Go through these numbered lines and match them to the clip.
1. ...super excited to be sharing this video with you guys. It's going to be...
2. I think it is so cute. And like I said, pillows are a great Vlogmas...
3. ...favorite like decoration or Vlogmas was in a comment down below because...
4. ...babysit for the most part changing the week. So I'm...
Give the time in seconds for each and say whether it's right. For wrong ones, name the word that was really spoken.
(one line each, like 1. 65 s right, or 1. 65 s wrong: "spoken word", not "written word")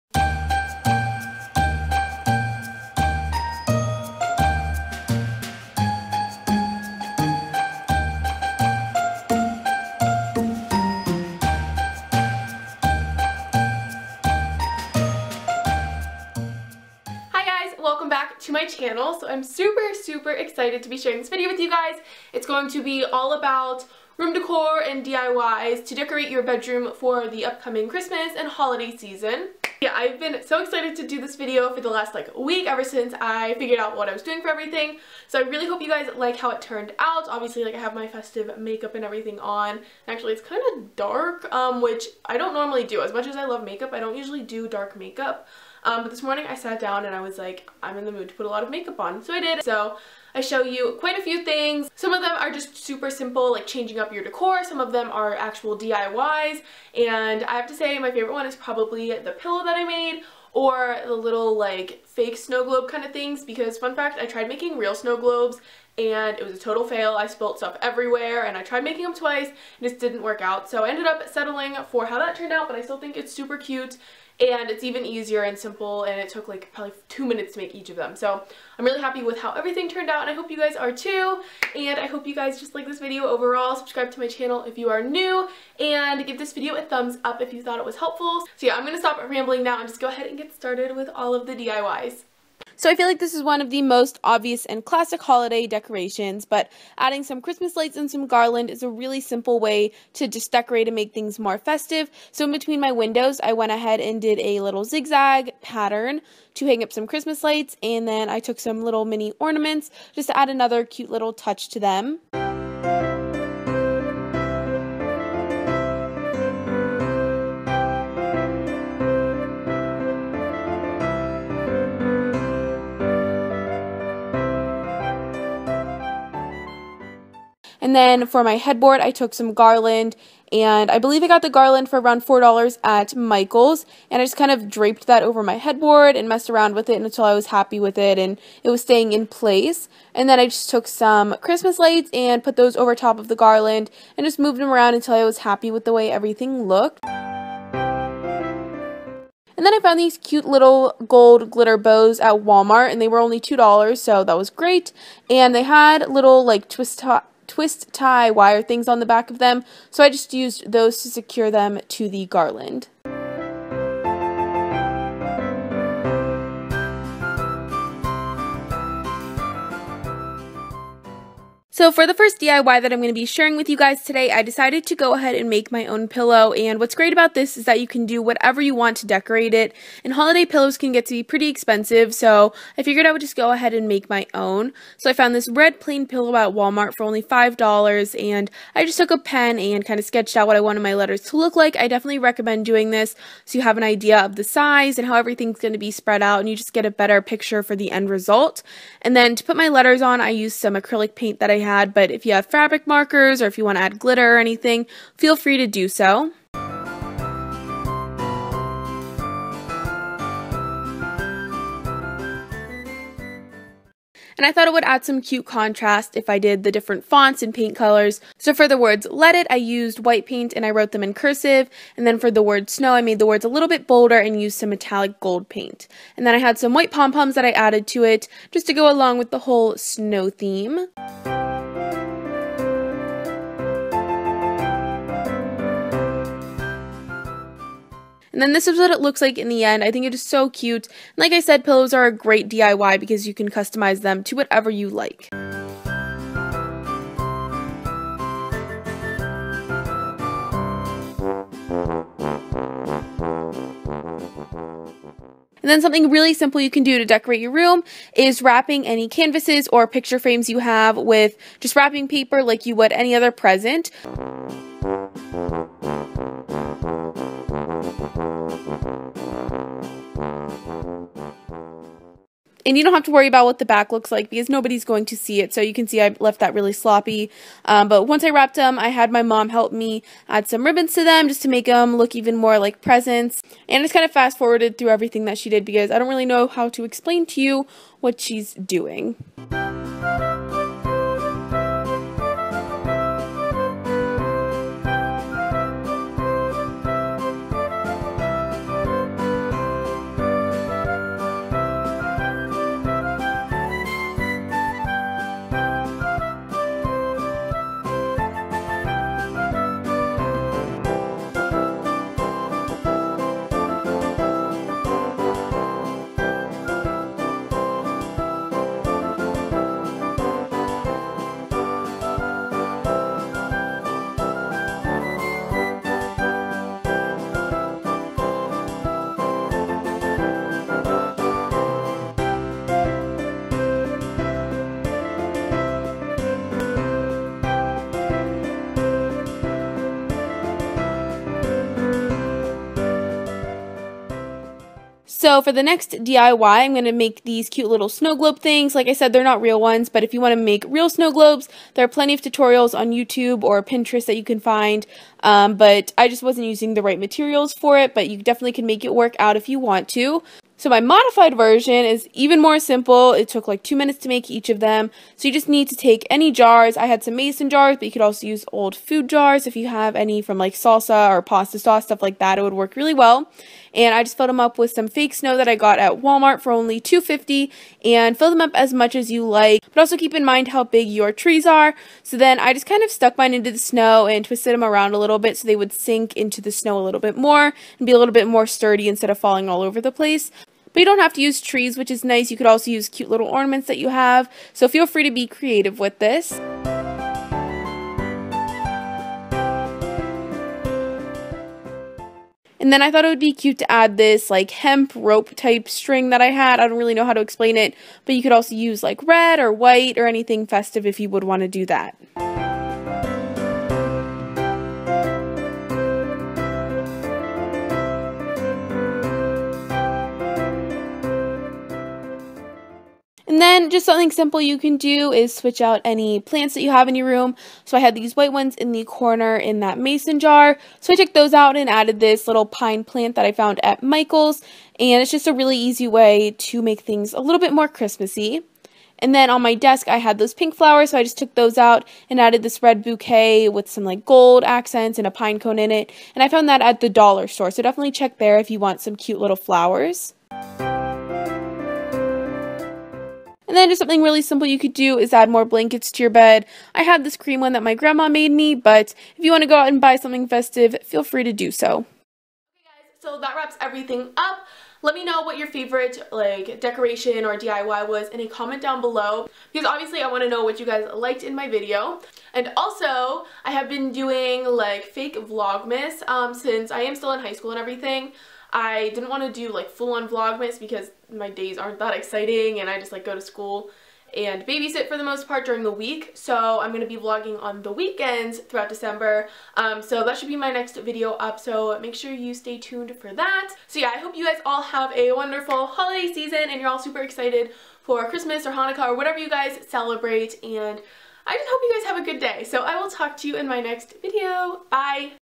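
1. 19 s right
2. 239 s wrong: "DIY", not "Vlogmas"
3. 465 s wrong: "DIY", not "Vlogmas"
4. 484 s wrong: "during", not "changing".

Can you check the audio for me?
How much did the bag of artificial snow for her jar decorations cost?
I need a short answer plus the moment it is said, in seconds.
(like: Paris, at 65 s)
$2.50, at 376 s.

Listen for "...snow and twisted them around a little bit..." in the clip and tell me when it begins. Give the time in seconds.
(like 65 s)
383 s.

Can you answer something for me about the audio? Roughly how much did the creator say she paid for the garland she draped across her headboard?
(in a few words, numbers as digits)
$4.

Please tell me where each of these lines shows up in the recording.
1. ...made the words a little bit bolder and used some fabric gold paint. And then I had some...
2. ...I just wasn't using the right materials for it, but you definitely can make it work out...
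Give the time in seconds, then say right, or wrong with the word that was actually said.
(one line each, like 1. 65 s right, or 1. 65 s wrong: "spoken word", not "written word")
1. 223 s wrong: "metallic", not "fabric"
2. 355 s right.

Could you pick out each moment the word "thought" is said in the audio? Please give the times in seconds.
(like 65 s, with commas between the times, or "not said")
87 s, 214 s, 402 s.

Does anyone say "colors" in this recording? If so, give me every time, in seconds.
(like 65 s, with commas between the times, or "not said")
217 s.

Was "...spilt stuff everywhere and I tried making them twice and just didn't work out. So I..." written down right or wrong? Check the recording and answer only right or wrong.
right.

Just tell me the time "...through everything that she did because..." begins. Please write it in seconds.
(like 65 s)
284 s.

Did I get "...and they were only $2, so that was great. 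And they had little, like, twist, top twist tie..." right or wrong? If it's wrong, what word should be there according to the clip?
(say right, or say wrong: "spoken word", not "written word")
right.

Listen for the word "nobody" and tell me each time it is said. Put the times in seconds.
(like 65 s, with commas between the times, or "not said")
274 s.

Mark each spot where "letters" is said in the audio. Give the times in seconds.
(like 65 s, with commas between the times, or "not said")
190 s, 199 s.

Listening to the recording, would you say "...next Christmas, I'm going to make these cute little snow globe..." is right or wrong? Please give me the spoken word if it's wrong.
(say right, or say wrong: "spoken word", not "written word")
wrong: "DIY", not "Christmas".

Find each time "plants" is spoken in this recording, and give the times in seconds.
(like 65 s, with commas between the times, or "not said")
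426 s, 432 s.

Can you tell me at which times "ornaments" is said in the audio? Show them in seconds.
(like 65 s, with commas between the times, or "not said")
109 s, 393 s.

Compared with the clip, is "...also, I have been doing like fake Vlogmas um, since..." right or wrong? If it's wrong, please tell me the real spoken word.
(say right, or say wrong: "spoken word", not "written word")
right.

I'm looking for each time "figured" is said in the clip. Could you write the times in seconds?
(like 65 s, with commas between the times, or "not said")
33 s, 182 s.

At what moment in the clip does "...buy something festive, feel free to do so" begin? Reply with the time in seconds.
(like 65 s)
459 s.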